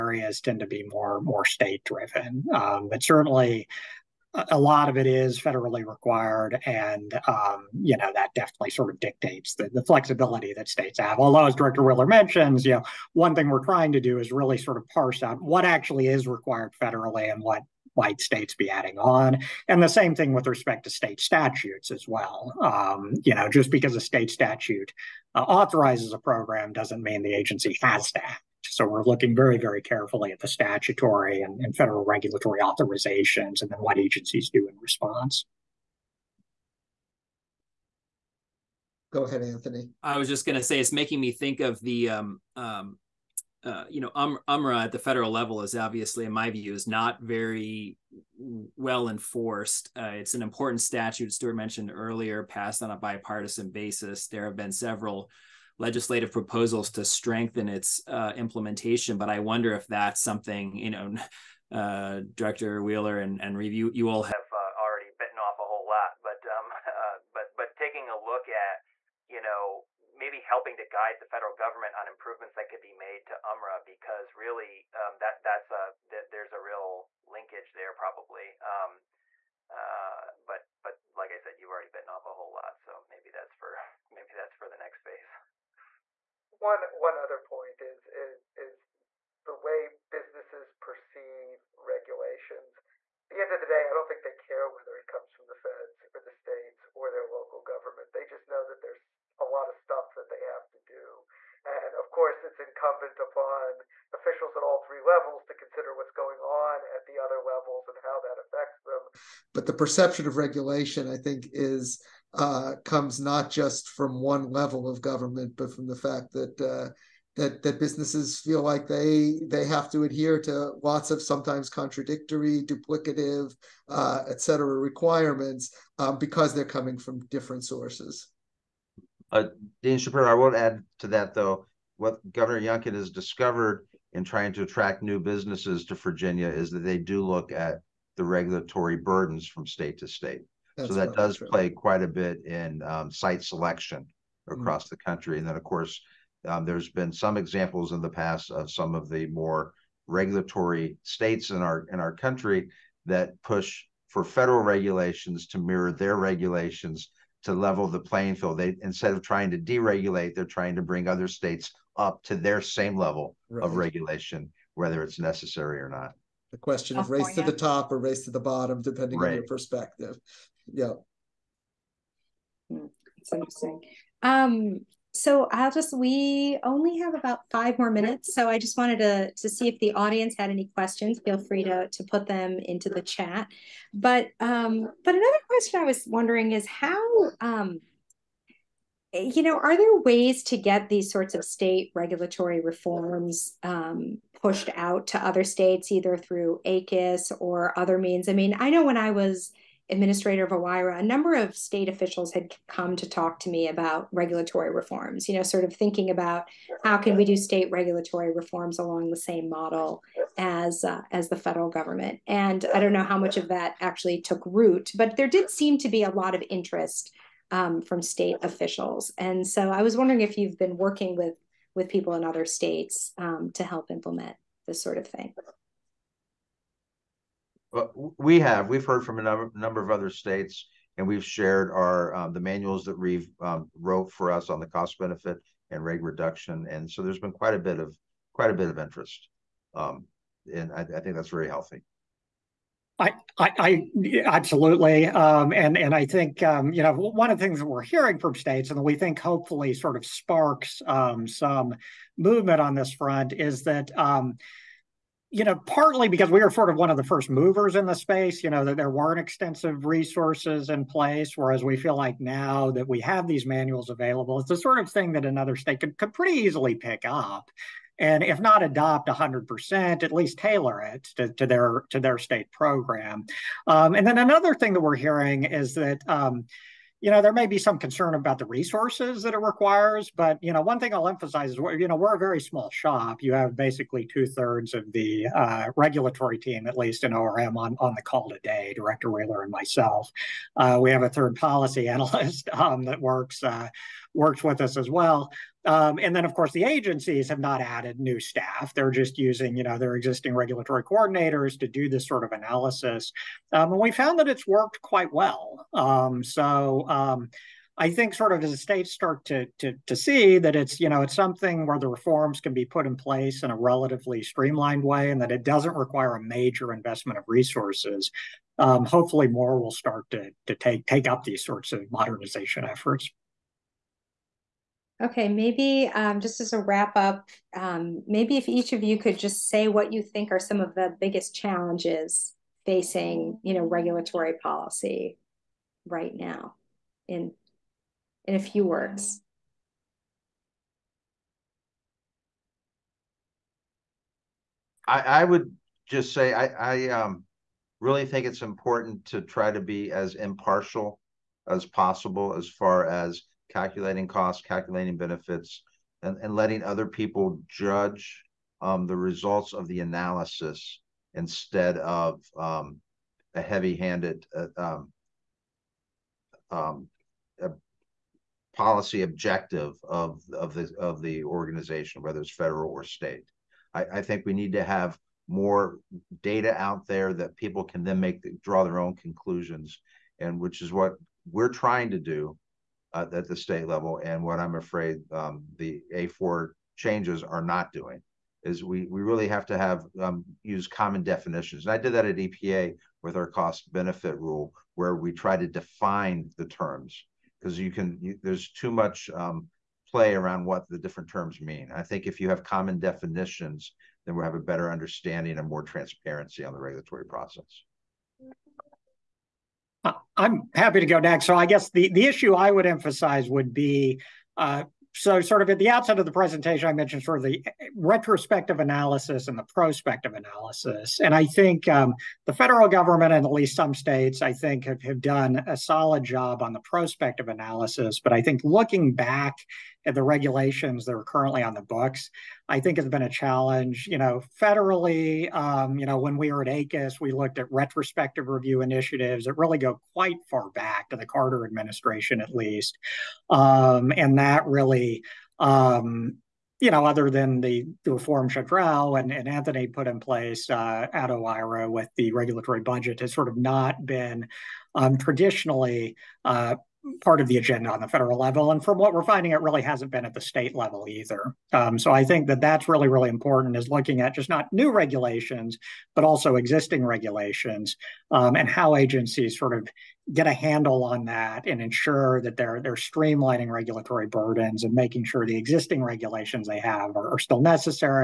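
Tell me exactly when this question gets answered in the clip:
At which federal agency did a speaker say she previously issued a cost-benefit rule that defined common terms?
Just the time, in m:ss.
6:32.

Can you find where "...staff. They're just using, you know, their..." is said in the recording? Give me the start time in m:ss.
4:58.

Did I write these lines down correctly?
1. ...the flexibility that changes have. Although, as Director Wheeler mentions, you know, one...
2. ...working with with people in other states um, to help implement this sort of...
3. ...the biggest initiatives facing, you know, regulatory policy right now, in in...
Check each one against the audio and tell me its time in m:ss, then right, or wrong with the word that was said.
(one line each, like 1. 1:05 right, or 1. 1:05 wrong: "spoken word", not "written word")
1. 0:09 wrong: "states", not "changes"
2. 3:40 right
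3. 5:30 wrong: "challenges", not "initiatives".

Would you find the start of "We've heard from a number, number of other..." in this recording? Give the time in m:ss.
3:48.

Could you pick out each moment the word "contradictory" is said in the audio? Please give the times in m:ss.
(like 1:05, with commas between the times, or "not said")
2:01.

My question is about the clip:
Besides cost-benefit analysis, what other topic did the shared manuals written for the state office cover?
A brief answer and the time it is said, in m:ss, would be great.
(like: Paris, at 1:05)
rate reduction, at 3:55.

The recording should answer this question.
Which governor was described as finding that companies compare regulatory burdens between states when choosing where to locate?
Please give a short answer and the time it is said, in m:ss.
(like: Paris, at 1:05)
Governor Youngkin, at 2:12.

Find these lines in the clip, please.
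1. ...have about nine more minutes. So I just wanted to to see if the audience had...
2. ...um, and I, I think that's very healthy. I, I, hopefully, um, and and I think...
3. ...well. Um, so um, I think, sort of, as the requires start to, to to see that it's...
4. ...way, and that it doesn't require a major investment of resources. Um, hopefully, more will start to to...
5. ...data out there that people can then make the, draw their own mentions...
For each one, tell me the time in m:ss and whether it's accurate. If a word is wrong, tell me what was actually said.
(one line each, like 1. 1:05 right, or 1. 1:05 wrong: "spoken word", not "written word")
1. 2:56 wrong: "five", not "nine"
2. 3:59 wrong: "absolutely", not "hopefully"
3. 5:05 wrong: "states", not "requires"
4. 5:14 right
5. 6:16 wrong: "conclusions", not "mentions".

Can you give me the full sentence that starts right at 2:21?
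play quite a bit in um, site selection mm-hmm.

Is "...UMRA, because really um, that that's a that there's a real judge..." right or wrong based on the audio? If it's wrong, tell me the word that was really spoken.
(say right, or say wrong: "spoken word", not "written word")
wrong: "linkage", not "judge".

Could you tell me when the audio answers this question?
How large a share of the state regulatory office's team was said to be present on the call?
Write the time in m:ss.
4:44.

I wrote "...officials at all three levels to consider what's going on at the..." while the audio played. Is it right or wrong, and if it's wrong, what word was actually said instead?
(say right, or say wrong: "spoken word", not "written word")
right.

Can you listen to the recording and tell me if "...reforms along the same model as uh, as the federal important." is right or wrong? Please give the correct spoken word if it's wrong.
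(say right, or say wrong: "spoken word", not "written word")
wrong: "government", not "important".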